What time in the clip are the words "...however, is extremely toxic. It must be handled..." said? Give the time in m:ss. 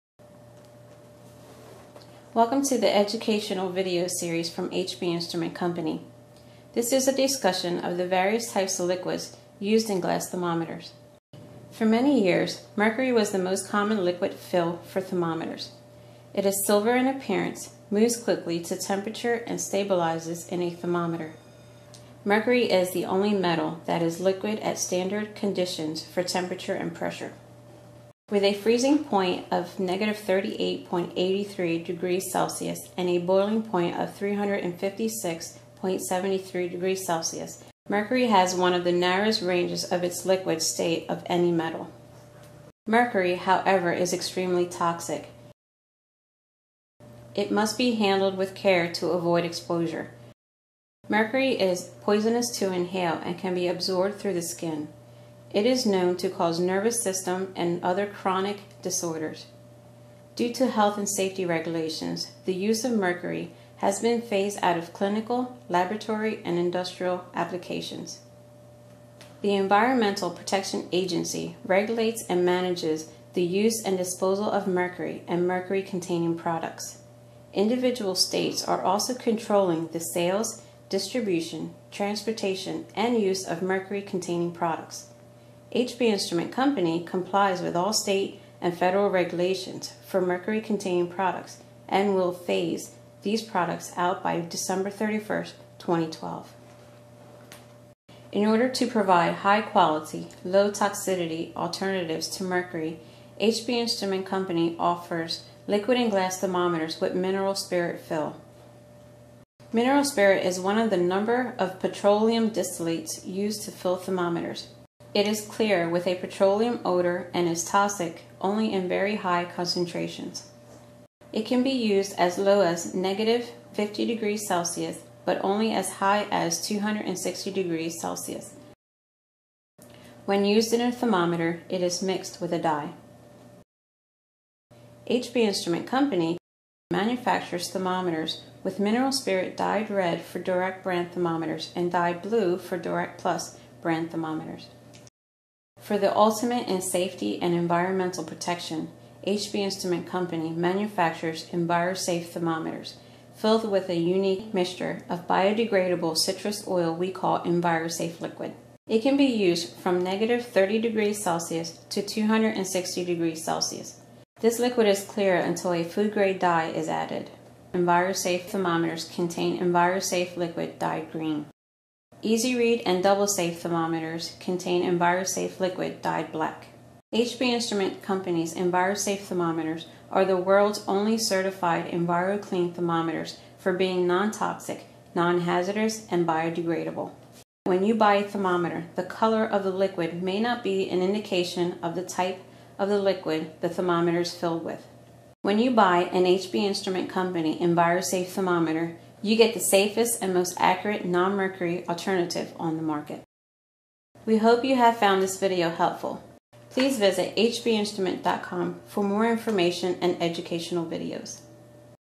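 0:43.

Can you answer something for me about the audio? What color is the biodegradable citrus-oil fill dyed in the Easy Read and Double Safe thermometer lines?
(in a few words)
Black.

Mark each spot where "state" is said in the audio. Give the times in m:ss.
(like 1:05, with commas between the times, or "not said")
0:40, 1:18, 1:27.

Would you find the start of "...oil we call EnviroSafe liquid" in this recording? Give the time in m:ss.
2:36.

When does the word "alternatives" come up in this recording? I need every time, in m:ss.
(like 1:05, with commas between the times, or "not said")
1:41, 3:21.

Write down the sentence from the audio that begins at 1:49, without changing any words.
Mineral spirit is one of the number of petroleum distillates used to fill thermometers.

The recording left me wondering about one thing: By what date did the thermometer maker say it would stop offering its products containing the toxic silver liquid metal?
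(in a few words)
December 31, 2012.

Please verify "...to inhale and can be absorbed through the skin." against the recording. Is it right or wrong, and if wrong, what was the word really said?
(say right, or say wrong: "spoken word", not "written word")
right.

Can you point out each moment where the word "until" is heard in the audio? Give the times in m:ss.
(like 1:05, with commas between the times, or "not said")
2:45.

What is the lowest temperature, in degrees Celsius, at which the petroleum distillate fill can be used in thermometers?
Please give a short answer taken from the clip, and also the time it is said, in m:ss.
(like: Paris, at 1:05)
-50, at 2:02.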